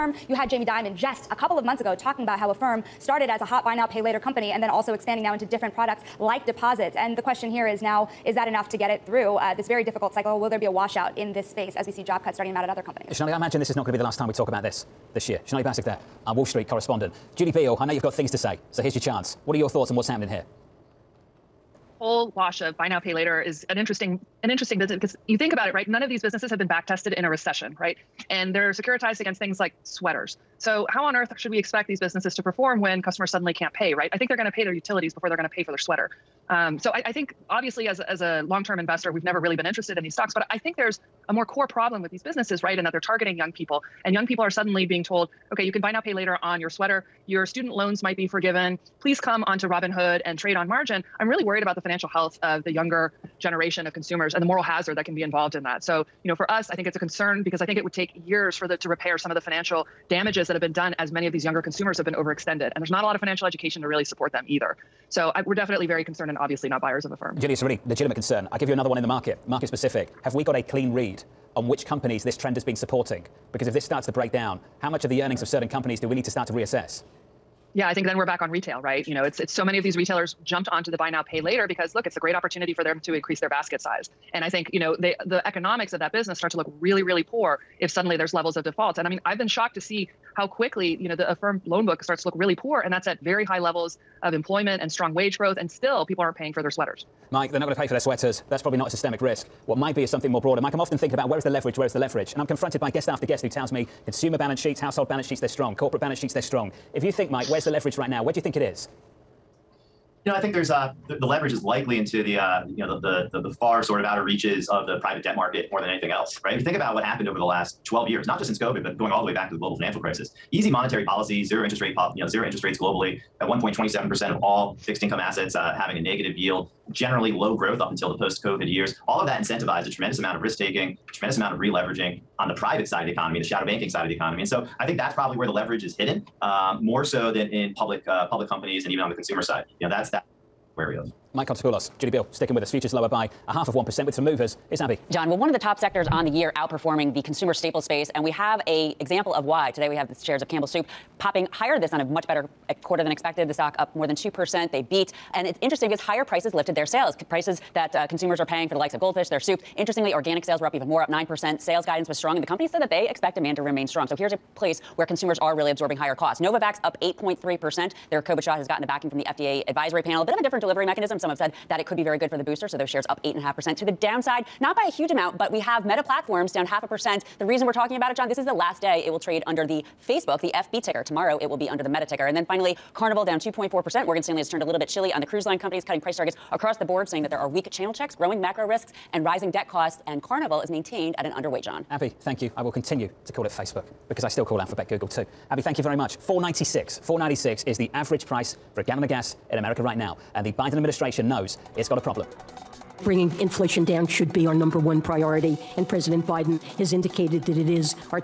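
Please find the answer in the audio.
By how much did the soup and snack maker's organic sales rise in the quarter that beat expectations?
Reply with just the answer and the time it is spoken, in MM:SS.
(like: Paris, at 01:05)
9%, at 02:41.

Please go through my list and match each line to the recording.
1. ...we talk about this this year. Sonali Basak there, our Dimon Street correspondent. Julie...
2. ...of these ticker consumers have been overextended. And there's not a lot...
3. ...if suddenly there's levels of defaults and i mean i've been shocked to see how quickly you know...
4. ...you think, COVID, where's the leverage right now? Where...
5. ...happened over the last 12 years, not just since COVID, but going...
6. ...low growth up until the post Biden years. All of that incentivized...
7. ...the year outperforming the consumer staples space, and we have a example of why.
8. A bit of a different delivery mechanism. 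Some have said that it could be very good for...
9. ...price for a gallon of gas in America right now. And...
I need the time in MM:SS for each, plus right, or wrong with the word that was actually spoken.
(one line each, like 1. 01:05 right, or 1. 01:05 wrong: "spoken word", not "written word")
1. 00:14 wrong: "Wall", not "Dimon"
2. 01:01 wrong: "younger", not "ticker"
3. 01:27 right
4. 01:47 wrong: "Mike", not "COVID"
5. 01:57 right
6. 02:07 wrong: "COVID", not "Biden"
7. 02:26 right
8. 02:50 right
9. 03:18 right.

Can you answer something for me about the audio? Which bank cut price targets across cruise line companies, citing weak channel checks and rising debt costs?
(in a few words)
Morgan Stanley.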